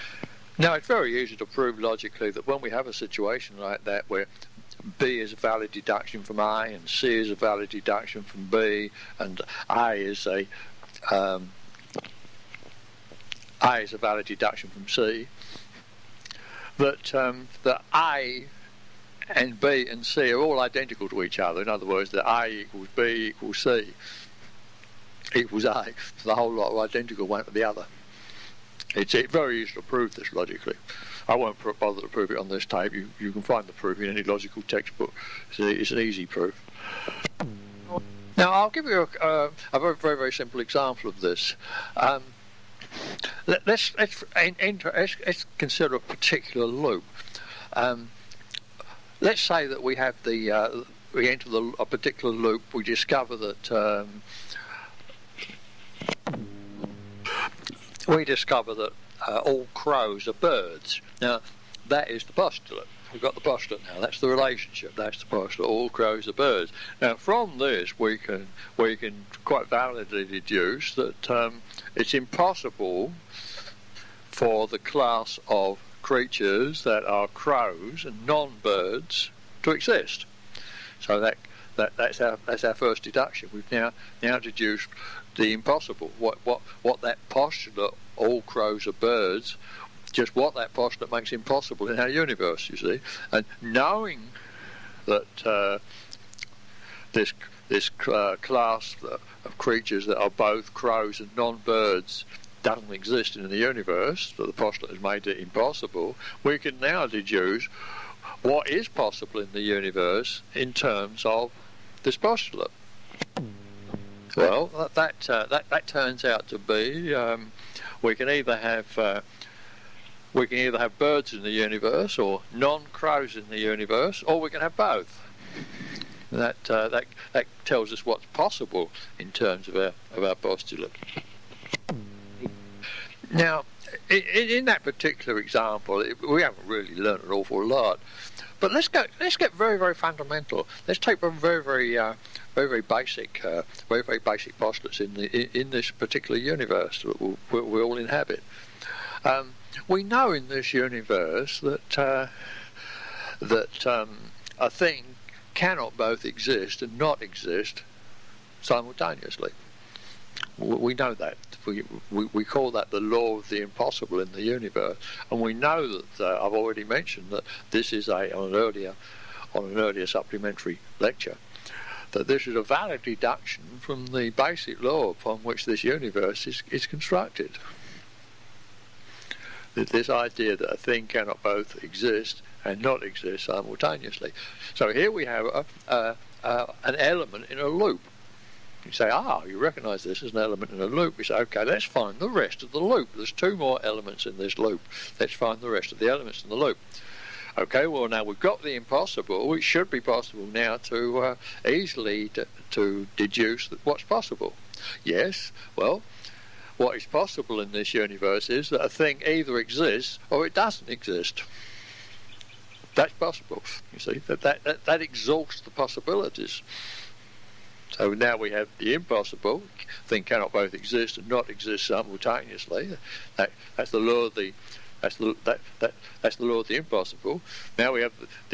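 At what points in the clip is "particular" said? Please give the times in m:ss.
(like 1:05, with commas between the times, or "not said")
0:45, 0:51, 2:14, 2:25.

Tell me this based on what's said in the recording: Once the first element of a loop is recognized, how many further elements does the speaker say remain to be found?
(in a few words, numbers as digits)
2.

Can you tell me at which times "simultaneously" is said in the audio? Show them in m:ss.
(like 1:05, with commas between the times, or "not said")
2:38, 3:03, 3:41.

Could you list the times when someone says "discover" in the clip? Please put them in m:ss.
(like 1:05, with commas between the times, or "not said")
0:52, 0:58.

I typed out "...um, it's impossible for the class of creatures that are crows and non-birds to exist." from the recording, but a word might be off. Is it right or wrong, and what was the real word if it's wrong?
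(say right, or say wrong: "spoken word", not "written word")
right.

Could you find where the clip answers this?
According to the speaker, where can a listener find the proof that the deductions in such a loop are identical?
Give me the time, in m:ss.
0:34.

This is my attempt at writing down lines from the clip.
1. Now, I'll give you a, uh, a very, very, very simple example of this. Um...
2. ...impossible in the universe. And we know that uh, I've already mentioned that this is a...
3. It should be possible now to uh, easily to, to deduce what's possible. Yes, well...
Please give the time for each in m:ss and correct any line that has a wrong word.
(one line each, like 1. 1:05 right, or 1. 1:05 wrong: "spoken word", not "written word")
1. 0:38 right
2. 2:43 right
3. 3:19 right.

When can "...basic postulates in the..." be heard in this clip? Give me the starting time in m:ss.
2:24.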